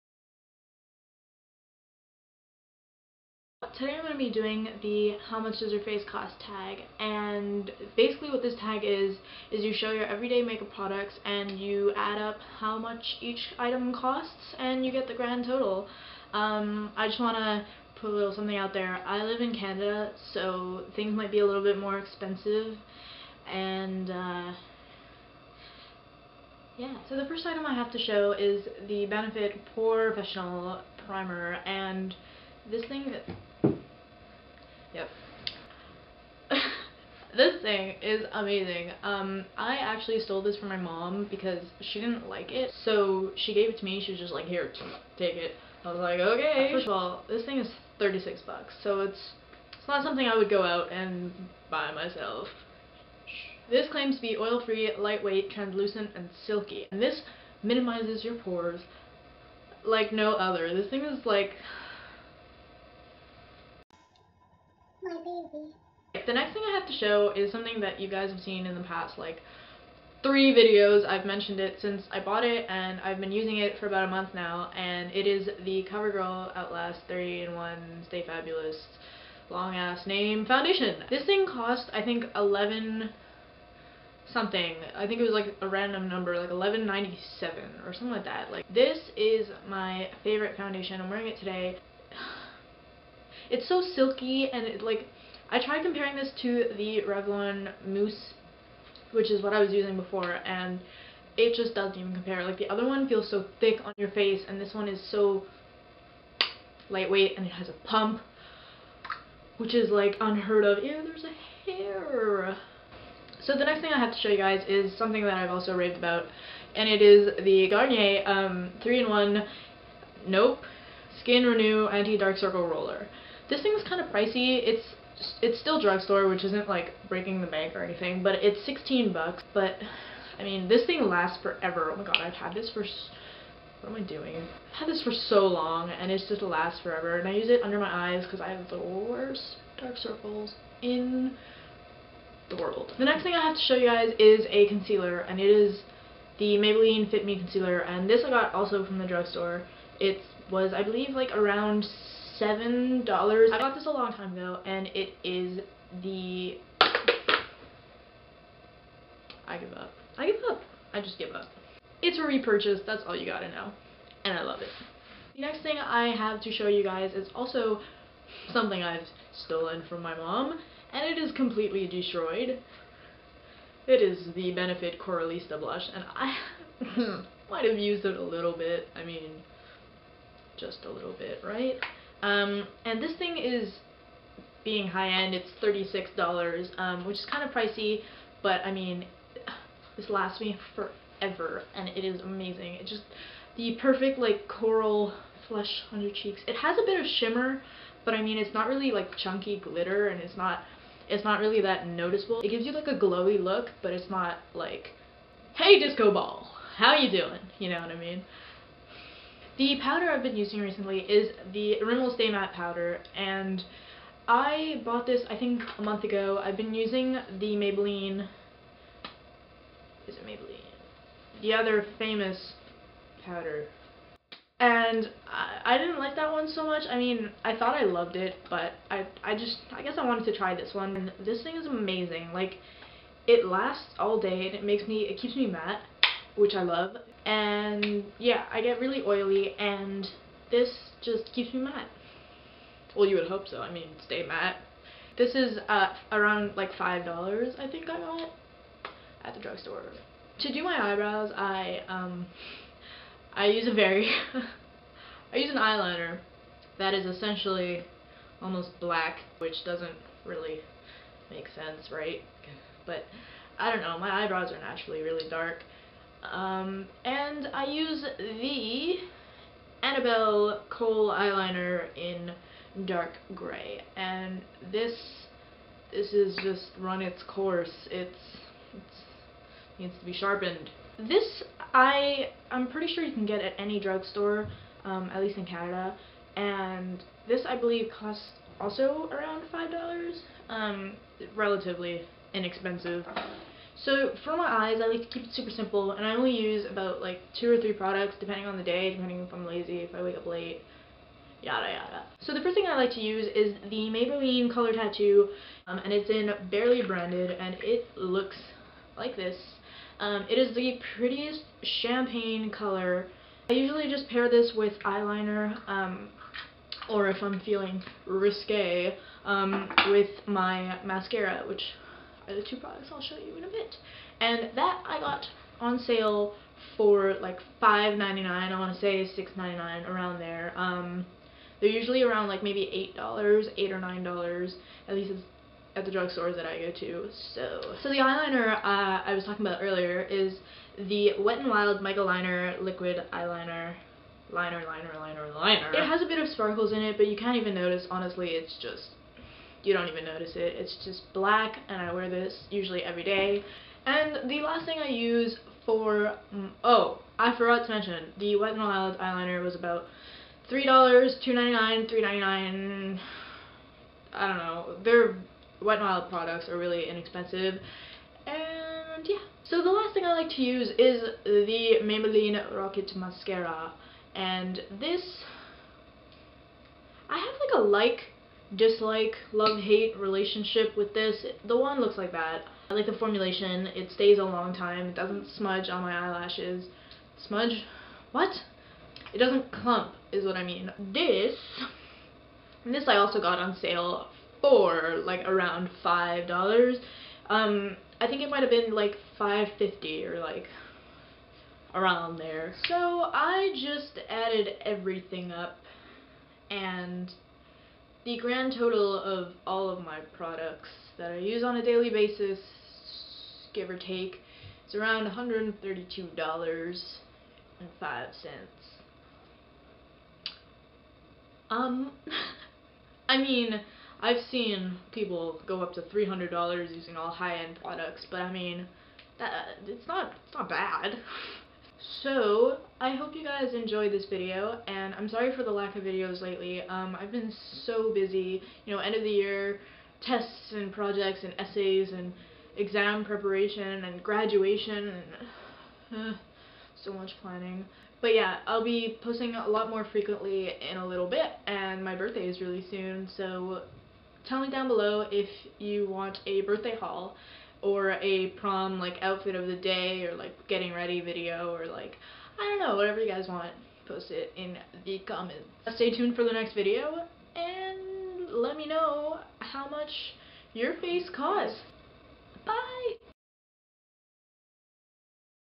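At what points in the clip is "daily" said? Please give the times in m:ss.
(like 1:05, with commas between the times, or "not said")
6:51.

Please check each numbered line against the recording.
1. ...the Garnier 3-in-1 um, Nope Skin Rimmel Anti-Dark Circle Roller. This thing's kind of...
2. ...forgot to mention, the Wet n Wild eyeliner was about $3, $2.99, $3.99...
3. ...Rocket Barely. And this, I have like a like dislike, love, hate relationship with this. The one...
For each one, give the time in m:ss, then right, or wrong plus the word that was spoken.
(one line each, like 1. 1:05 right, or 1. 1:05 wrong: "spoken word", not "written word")
1. 1:57 wrong: "Renew", not "Rimmel"
2. 5:57 right
3. 6:12 wrong: "Mascara", not "Barely".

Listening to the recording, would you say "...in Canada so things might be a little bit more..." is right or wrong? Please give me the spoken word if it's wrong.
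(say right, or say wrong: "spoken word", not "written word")
right.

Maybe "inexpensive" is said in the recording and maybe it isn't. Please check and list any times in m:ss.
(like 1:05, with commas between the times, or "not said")
4:52, 6:06.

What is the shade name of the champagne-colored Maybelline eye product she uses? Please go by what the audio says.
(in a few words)
Barely Branded.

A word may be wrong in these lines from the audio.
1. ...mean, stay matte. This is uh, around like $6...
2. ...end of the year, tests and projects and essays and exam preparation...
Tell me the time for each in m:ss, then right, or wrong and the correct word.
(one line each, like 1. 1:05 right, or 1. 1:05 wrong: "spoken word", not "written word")
1. 4:03 wrong: "5", not "6"
2. 7:18 right.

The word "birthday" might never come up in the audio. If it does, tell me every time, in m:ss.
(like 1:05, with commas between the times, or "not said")
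7:31, 7:36.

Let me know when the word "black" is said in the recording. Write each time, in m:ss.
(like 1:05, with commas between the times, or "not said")
4:18, 5:51.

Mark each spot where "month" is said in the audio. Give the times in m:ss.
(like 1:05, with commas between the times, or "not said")
1:14, 3:35.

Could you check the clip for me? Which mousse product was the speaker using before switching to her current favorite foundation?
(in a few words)
Revlon Mousse.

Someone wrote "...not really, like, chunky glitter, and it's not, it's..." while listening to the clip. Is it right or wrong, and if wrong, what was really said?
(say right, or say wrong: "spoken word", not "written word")
right.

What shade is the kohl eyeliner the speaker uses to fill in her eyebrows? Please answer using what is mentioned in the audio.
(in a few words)
dark gray.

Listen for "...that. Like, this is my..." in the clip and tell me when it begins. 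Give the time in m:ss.
1:28.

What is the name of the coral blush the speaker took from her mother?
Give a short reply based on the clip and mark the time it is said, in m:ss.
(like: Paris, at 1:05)
Benefit Coralista, at 2:54.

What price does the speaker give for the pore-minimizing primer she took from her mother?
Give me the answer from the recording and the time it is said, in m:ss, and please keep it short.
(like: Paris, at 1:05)
$36, at 0:47.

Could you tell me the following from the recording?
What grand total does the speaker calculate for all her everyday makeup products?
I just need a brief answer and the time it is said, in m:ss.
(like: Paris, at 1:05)
$132.05, at 6:55.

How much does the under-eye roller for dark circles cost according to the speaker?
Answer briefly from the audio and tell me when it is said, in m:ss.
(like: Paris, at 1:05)
$16, at 2:08.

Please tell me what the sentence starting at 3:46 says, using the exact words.
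I mean, I thought I loved it, but I, I just, I guess I wanted to try this one.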